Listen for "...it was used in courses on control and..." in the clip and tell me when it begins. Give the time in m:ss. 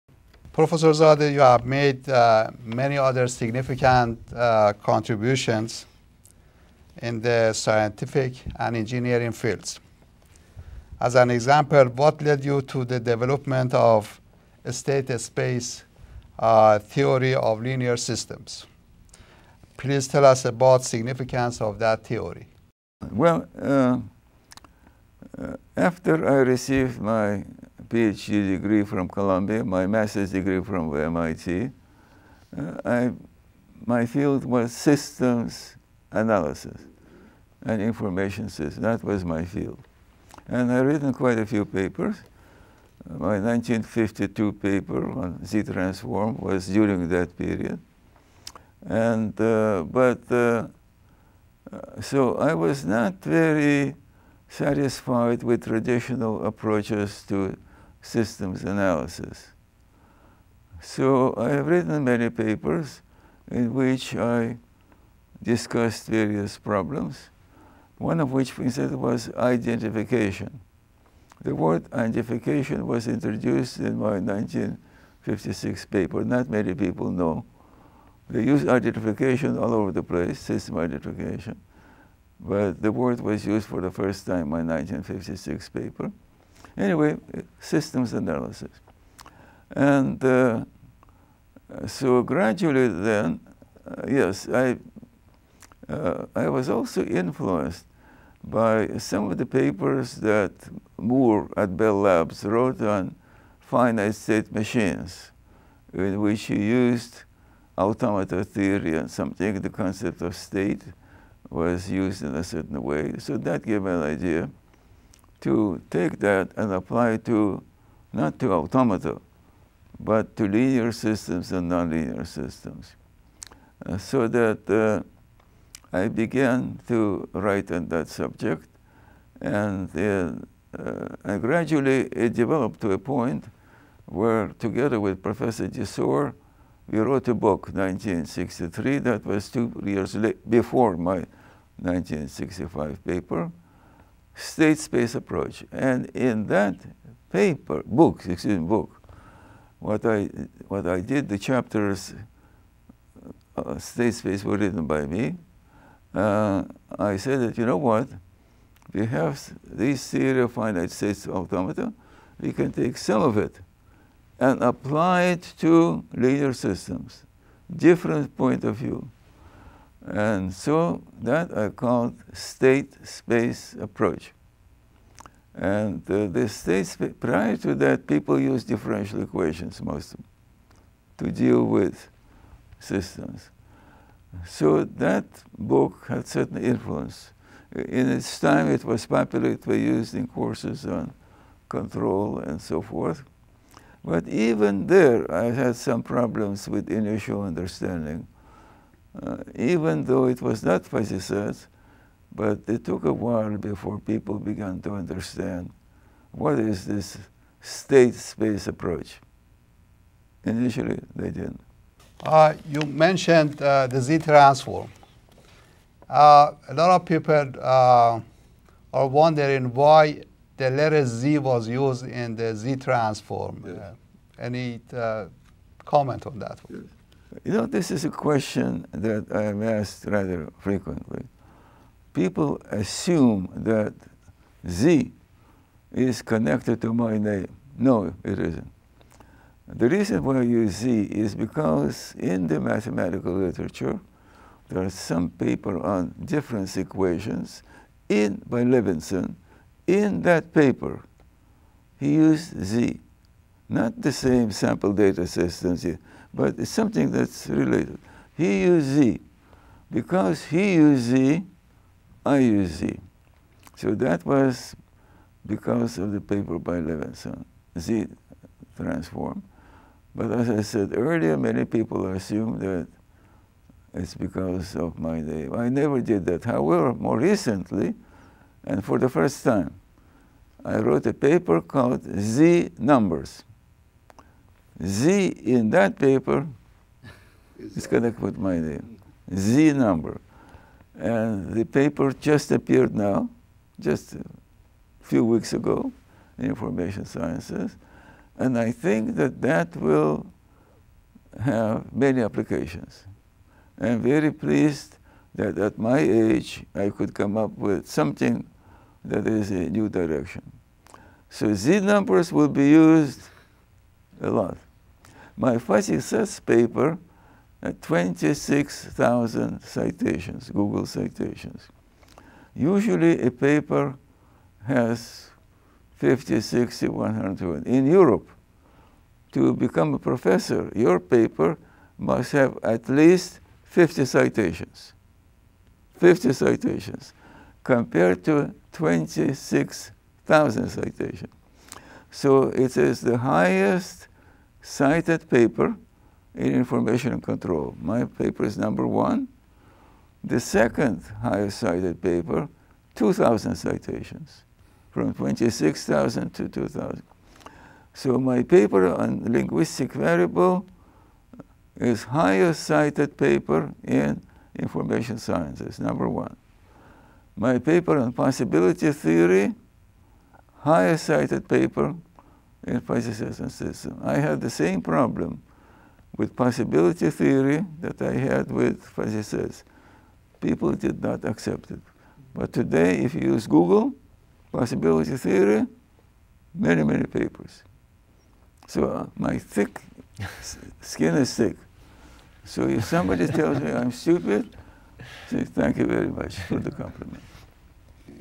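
3:09.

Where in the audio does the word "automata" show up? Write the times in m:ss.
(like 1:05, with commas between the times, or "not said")
1:47, 1:58, 2:41.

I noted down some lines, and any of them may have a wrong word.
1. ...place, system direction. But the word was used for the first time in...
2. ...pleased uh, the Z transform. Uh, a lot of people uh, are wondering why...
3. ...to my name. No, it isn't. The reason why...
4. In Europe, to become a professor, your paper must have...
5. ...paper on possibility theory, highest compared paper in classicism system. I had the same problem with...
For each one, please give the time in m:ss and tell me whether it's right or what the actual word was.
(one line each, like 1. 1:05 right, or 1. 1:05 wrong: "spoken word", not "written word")
1. 1:20 wrong: "identification", not "direction"
2. 3:32 wrong: "mentioned", not "pleased"
3. 3:56 right
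4. 5:27 right
5. 6:07 wrong: "cited", not "compared".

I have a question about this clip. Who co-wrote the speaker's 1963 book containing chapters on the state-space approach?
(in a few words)
Professor Desoer.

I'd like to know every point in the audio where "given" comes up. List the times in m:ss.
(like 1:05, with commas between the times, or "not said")
not said.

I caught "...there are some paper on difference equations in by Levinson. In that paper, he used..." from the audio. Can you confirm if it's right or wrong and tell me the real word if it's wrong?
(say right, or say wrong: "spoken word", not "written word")
right.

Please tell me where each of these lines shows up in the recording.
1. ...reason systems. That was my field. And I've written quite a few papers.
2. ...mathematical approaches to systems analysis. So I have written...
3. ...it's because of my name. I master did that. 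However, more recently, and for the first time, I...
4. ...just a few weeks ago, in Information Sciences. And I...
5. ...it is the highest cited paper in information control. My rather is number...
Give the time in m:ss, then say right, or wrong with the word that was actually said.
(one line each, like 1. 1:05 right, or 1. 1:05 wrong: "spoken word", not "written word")
1. 0:37 wrong: "information", not "reason"
2. 0:55 wrong: "traditional", not "mathematical"
3. 4:33 wrong: "never", not "master"
4. 4:53 right
5. 5:42 wrong: "paper", not "rather".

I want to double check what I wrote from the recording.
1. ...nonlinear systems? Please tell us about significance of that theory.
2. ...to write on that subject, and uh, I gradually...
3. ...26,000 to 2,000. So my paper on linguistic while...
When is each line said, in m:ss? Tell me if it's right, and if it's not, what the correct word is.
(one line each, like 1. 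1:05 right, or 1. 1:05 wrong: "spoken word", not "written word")
1. 0:17 wrong: "linear", not "nonlinear"
2. 2:06 right
3. 5:55 wrong: "variable", not "while".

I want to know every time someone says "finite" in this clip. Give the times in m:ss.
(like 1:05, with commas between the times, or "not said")
1:43, 2:40.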